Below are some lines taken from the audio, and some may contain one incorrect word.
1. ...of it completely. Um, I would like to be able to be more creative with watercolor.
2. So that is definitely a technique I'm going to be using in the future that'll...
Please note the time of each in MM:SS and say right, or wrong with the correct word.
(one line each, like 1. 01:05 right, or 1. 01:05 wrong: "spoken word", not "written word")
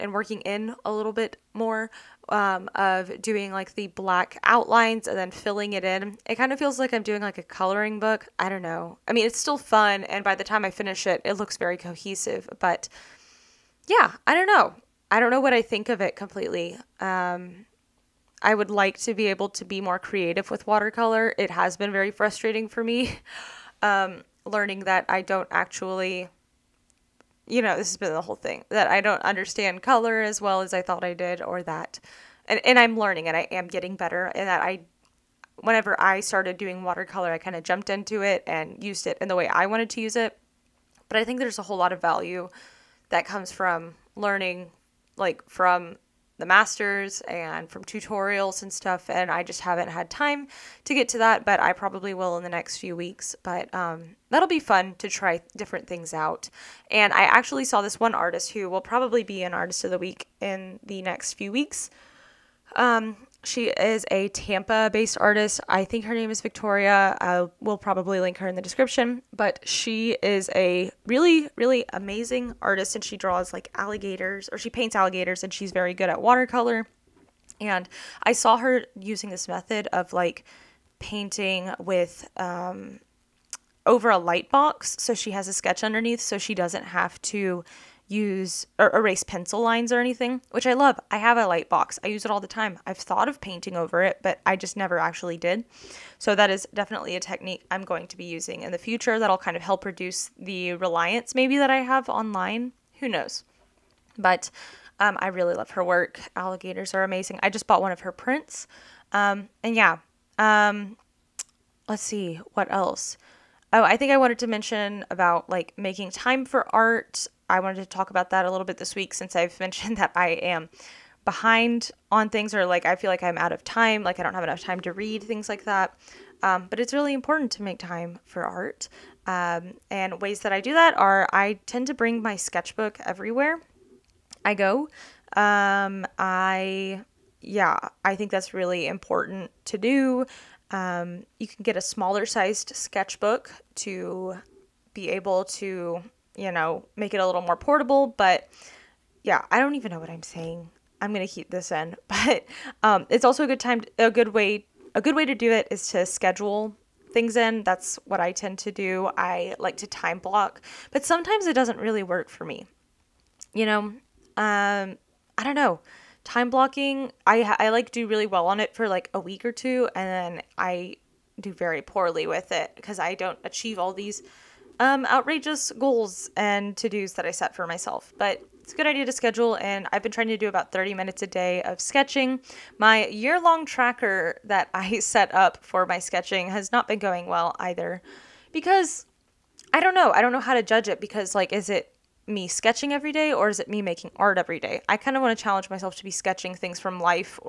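1. 00:15 right
2. 01:36 right.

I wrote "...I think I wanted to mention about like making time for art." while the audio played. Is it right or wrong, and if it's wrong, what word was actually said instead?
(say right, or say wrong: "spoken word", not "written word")
right.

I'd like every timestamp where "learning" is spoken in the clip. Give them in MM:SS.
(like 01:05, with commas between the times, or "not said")
00:24, 00:32, 00:44.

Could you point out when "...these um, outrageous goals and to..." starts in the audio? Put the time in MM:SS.
02:53.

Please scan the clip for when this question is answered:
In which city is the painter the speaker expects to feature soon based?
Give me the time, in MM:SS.
01:04.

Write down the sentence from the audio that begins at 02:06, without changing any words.
Um, but it's really important to make time for art.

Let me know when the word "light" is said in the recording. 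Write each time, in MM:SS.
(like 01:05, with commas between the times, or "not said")
01:24, 01:31.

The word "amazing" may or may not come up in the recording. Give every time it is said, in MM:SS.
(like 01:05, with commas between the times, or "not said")
01:11, 01:47.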